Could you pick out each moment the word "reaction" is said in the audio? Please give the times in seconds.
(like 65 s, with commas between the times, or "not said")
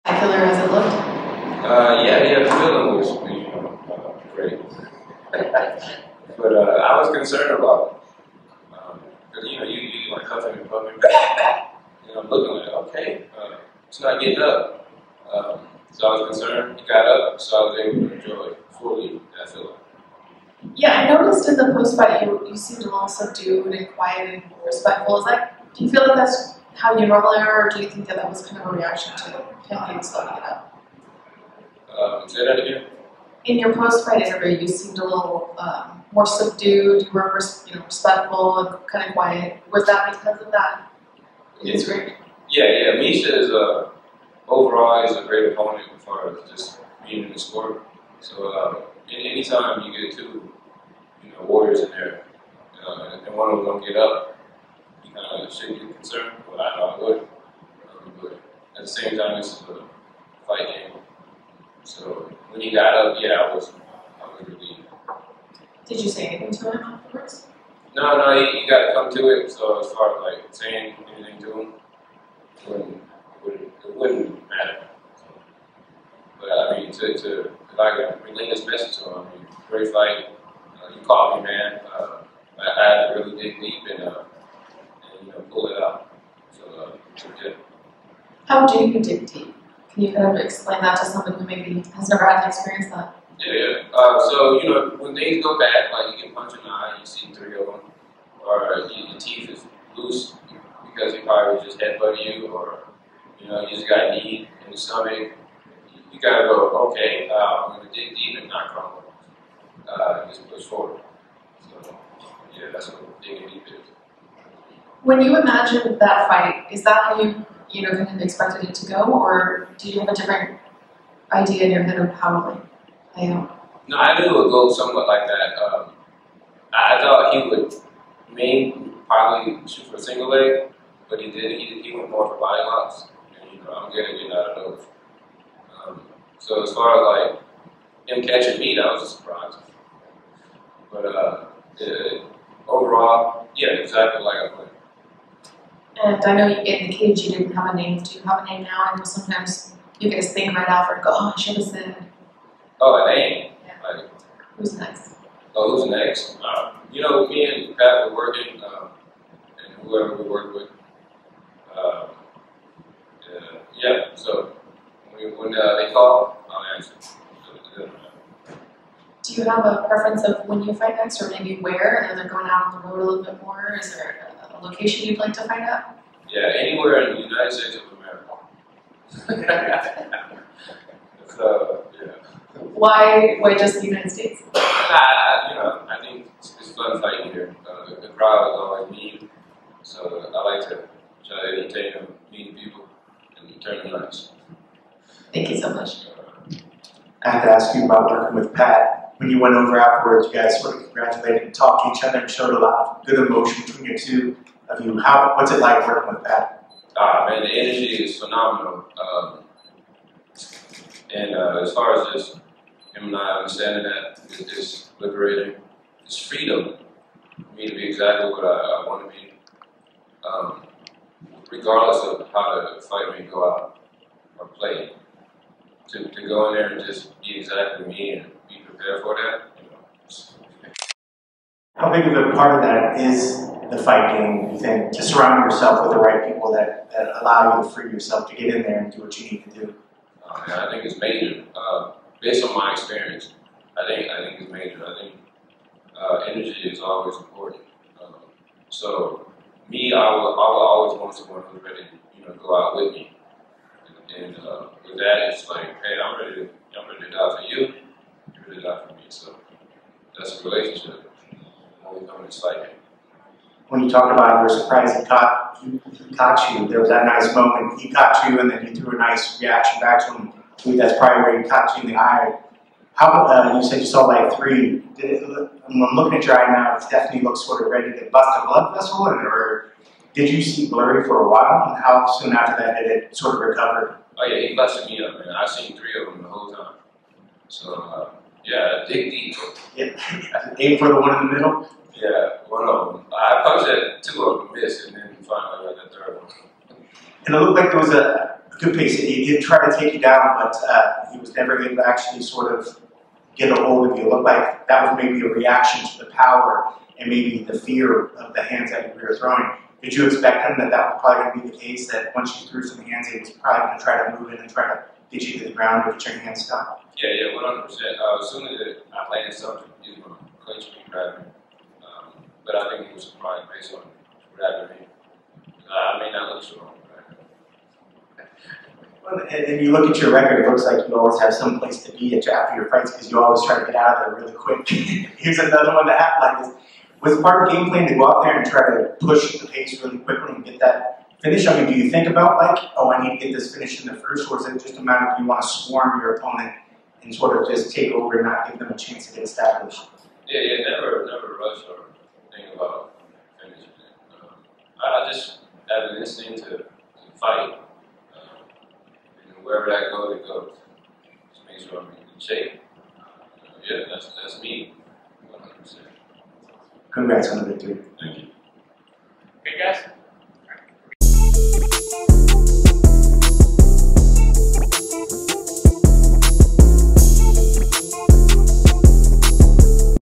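28 s, 269 s, 305 s.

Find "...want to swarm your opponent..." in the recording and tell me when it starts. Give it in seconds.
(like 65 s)
345 s.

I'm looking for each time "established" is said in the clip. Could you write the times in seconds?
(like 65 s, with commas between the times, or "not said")
349 s.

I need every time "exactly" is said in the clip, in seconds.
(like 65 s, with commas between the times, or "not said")
143 s, 217 s, 227 s.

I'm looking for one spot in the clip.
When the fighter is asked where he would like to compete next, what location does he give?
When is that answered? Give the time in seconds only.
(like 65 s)
177 s.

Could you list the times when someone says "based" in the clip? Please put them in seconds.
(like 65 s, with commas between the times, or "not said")
242 s, 323 s.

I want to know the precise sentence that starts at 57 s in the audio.
Um, but at the same time, it's a fight game.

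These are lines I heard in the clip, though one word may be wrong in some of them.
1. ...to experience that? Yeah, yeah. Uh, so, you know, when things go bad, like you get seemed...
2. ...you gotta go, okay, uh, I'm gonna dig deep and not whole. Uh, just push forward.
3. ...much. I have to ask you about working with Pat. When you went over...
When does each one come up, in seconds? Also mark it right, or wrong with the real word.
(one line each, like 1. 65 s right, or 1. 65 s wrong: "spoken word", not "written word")
1. 92 s wrong: "punched", not "seemed"
2. 106 s wrong: "crumble", not "whole"
3. 195 s right.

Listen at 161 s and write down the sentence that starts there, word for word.
Um, uh, yeah, so when, when uh, they call, I'll answer.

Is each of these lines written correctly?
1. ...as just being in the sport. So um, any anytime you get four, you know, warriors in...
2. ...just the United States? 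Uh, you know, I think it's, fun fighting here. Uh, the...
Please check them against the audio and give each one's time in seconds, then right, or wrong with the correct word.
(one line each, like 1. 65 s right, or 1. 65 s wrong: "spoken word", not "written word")
1. 46 s wrong: "two", not "four"
2. 183 s right.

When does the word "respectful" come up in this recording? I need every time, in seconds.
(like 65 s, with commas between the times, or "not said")
24 s, 37 s.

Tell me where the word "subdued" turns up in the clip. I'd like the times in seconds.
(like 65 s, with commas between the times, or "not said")
23 s, 36 s.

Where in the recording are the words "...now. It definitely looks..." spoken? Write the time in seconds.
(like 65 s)
276 s.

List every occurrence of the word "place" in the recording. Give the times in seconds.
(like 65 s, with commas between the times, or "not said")
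331 s.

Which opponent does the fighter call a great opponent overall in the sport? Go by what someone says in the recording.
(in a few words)
Misha.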